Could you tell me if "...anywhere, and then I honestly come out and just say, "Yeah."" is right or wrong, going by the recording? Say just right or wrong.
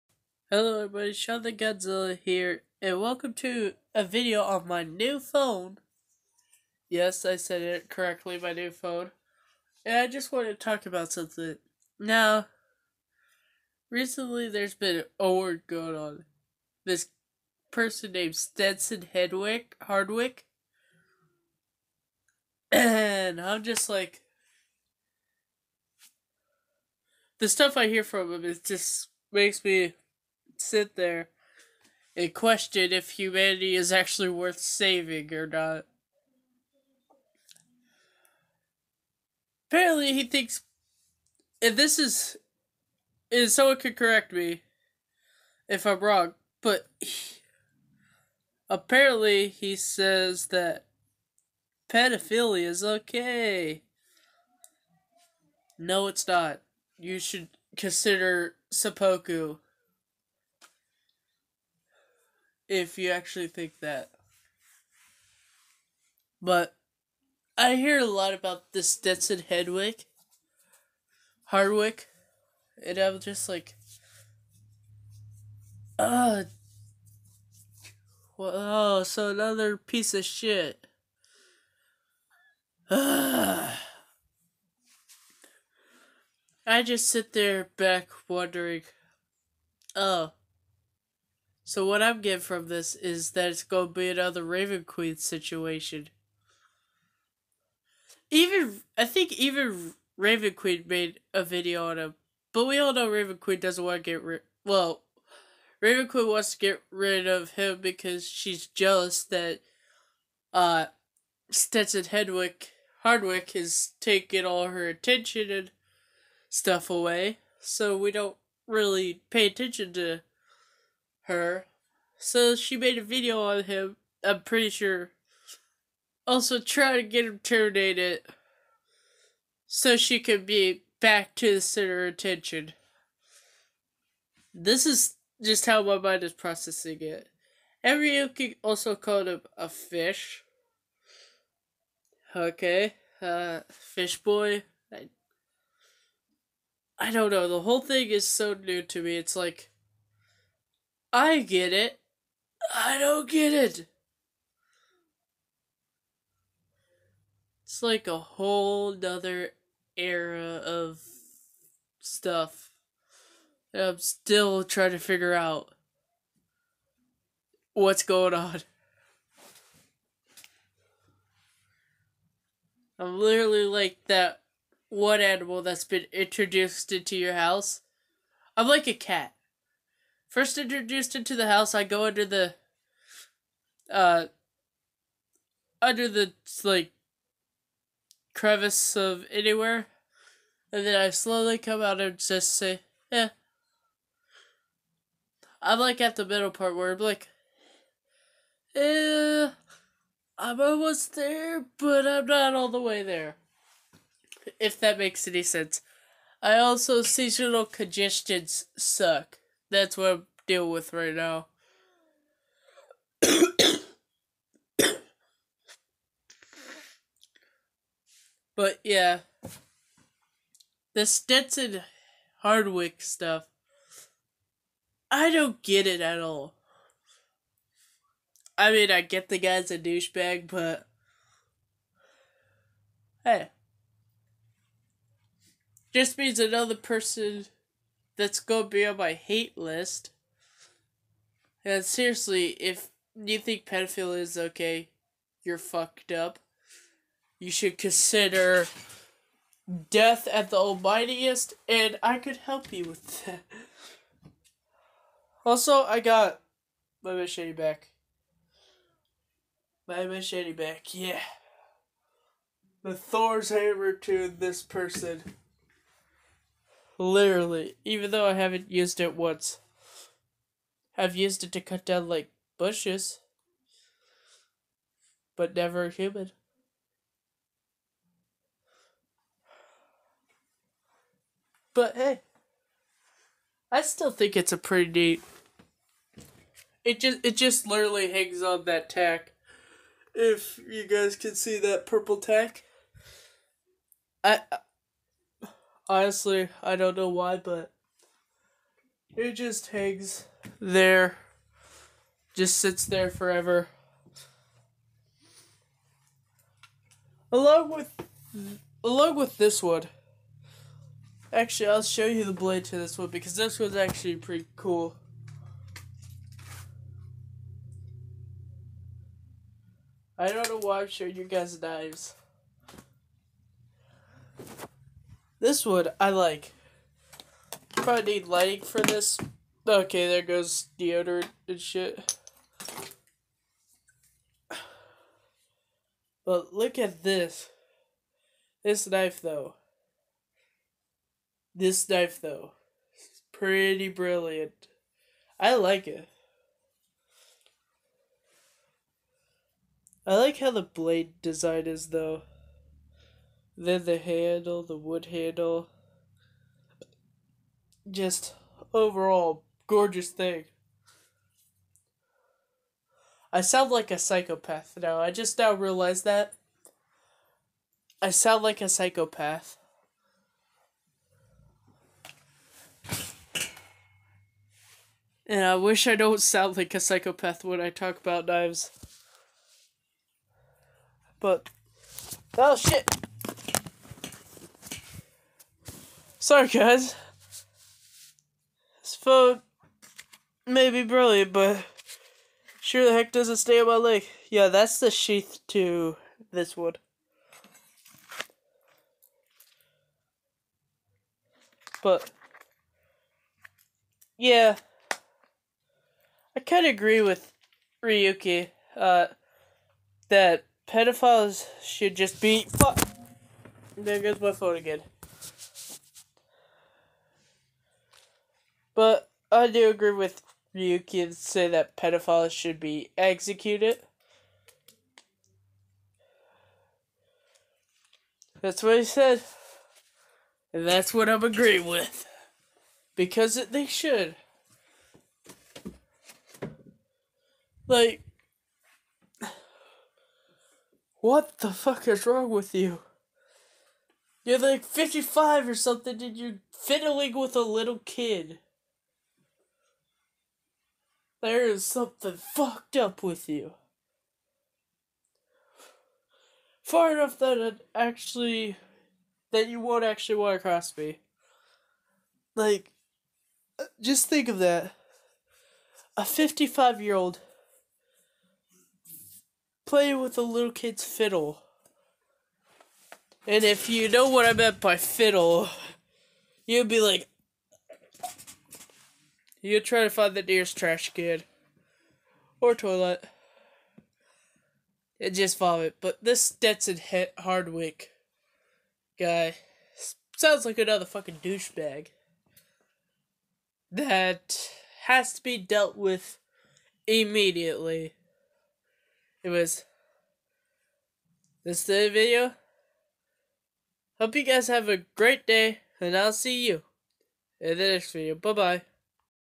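wrong.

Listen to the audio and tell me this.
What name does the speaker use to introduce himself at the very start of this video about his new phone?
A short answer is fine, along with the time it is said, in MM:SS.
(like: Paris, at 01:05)
Sean the Godzilla, at 00:01.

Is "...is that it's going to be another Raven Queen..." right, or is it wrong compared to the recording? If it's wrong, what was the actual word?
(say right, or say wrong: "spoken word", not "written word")
right.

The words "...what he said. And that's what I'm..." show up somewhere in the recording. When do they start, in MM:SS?
07:08.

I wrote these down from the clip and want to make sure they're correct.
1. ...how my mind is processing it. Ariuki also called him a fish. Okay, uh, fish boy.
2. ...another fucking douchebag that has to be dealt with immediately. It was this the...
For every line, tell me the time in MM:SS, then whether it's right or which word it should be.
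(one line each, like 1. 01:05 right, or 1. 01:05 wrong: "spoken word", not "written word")
1. 02:15 right
2. 08:10 right.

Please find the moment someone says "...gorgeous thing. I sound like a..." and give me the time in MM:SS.
05:59.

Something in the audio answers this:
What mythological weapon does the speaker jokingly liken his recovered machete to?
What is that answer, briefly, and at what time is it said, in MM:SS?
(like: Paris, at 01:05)
Thor's hammer, at 04:22.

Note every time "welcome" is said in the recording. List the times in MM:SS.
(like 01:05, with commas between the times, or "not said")
00:03.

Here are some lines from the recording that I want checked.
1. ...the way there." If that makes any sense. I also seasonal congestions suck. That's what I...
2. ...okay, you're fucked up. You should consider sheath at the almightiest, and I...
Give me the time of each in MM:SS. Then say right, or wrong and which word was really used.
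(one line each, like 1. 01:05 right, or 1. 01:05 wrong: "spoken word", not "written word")
1. 03:22 right
2. 04:04 wrong: "death", not "sheath".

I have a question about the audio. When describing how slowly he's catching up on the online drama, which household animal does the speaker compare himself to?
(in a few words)
A cat.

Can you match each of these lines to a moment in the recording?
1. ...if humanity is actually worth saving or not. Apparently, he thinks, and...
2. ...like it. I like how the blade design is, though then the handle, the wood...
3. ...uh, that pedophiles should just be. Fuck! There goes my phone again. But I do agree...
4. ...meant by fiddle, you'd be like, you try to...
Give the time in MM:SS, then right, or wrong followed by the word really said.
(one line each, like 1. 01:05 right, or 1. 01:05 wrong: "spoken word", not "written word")
1. 00:32 right
2. 05:45 right
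3. 06:48 right
4. 07:54 right.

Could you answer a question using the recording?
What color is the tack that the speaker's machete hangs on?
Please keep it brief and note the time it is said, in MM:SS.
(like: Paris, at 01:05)
Purple, at 04:51.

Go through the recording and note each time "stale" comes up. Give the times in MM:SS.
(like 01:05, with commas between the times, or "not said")
not said.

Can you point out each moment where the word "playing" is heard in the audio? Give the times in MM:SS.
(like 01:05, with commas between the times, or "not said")
07:49.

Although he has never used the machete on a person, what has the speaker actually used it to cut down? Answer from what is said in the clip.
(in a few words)
Bushes.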